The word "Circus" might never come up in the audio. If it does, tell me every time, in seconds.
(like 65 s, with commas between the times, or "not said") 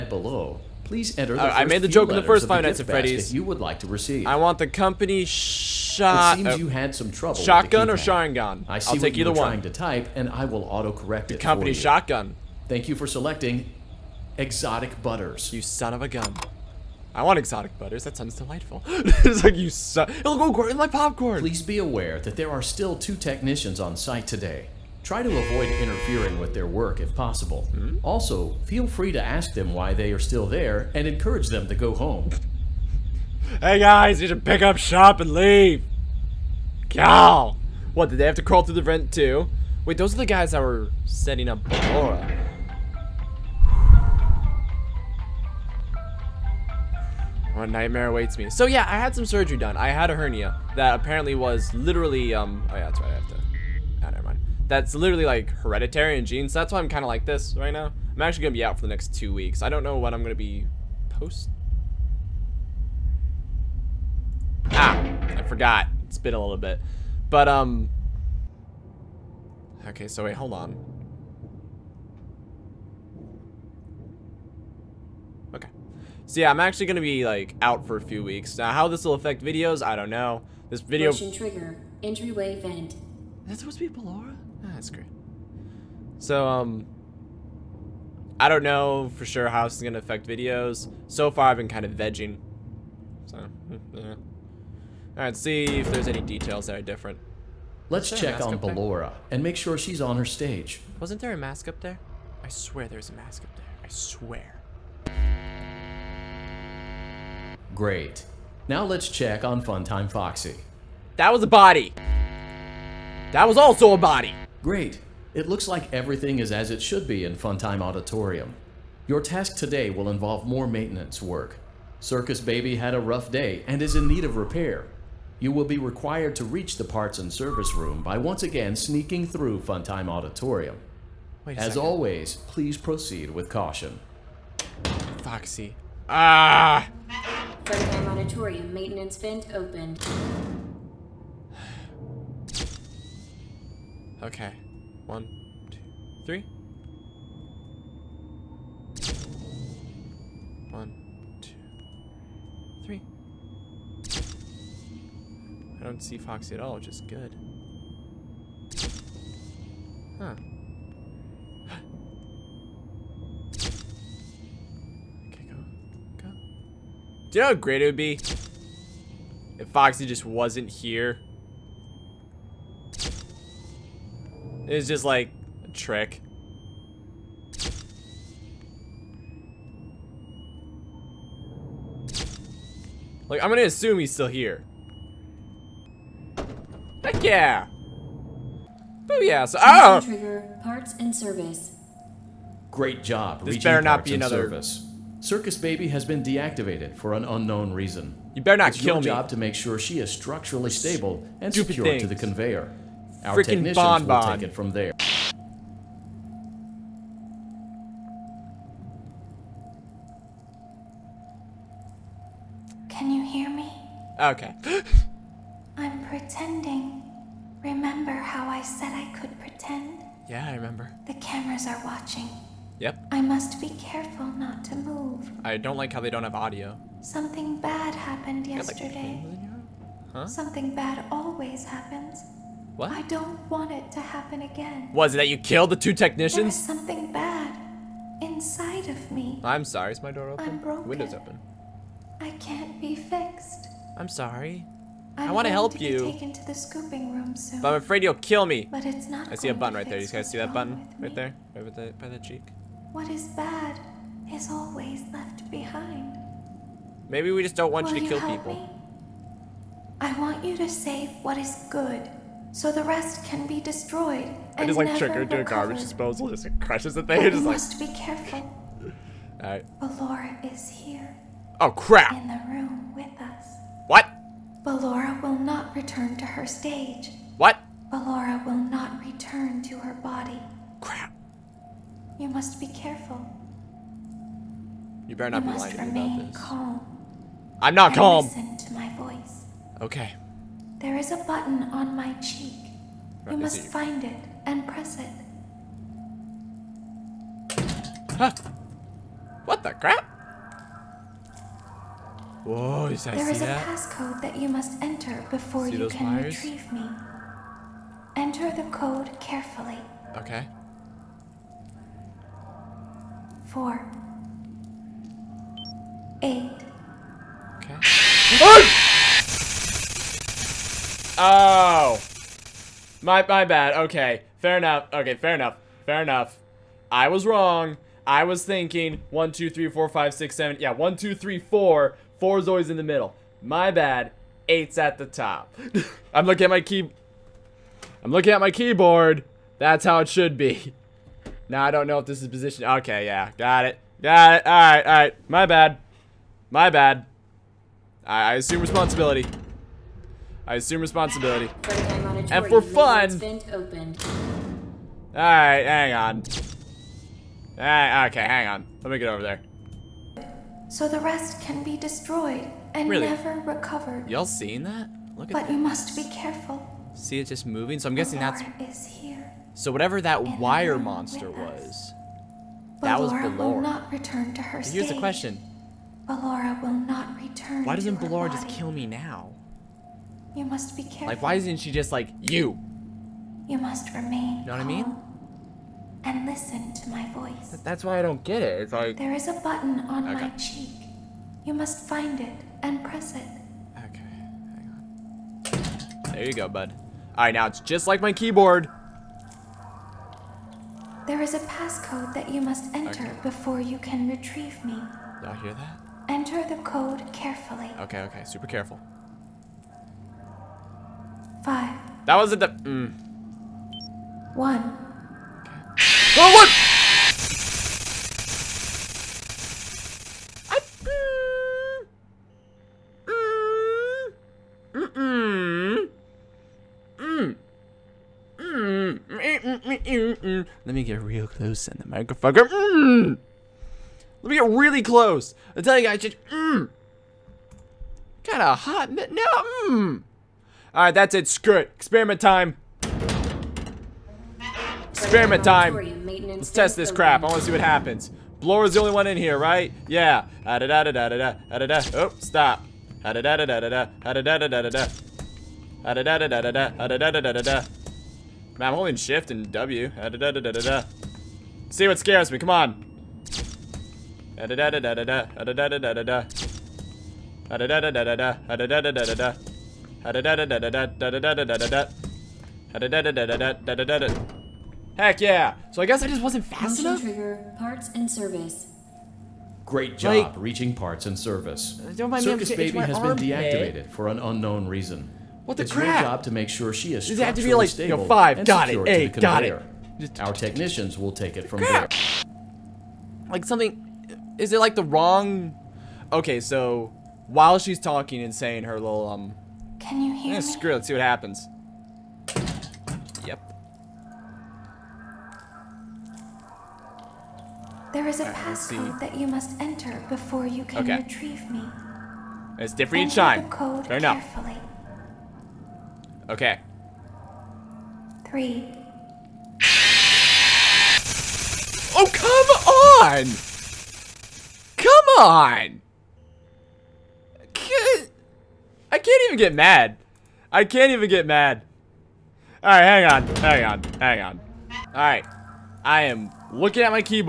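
122 s, 195 s, 482 s.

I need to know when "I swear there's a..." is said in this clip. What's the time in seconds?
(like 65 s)
102 s.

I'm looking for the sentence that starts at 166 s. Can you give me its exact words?
Do you know how great it would be?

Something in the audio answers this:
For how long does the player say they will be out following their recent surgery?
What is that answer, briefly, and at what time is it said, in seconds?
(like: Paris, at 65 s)
Two weeks, at 58 s.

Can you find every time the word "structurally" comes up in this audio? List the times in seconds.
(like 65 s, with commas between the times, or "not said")
200 s, 487 s.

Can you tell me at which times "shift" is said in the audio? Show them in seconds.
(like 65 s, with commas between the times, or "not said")
458 s.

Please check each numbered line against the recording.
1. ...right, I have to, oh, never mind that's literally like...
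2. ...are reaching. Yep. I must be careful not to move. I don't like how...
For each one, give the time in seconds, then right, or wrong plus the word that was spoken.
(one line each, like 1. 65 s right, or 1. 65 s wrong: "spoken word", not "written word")
1. 53 s right
2. 221 s wrong: "watching", not "reaching".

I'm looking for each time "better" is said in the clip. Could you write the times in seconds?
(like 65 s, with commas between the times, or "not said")
193 s, 198 s, 285 s.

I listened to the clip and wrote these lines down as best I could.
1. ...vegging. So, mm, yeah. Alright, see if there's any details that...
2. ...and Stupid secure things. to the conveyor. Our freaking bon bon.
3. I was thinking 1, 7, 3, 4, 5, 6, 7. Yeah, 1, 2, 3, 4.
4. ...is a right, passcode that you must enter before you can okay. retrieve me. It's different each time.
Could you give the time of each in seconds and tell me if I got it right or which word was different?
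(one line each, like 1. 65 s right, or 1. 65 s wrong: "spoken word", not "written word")
1. 91 s right
2. 201 s right
3. 328 s wrong: "2", not "7"
4. 508 s right.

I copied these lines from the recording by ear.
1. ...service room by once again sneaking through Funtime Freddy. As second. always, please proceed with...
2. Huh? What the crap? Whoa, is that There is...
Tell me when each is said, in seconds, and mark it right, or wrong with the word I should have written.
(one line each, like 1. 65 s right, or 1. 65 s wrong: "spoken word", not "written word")
1. 127 s wrong: "Auditorium", not "Freddy"
2. 298 s right.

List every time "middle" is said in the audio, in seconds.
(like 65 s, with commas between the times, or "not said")
332 s.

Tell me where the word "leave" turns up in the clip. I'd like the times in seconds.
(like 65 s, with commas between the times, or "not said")
35 s.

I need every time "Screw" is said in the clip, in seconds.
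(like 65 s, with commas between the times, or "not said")
441 s, 500 s.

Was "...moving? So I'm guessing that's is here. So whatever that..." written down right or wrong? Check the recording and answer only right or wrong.
right.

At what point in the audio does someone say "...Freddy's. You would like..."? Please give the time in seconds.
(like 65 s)
2 s.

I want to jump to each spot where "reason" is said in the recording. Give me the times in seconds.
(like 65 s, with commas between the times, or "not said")
197 s, 484 s.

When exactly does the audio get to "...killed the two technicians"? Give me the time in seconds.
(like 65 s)
235 s.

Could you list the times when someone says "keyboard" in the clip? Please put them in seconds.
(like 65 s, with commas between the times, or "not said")
338 s, 398 s.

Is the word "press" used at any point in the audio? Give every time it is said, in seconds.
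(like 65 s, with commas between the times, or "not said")
294 s, 392 s.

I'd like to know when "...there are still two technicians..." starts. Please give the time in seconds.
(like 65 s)
22 s.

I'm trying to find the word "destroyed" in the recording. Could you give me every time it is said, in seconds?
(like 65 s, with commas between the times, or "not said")
263 s, 361 s.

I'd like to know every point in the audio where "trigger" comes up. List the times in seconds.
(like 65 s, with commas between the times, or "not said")
81 s, 190 s, 264 s, 477 s.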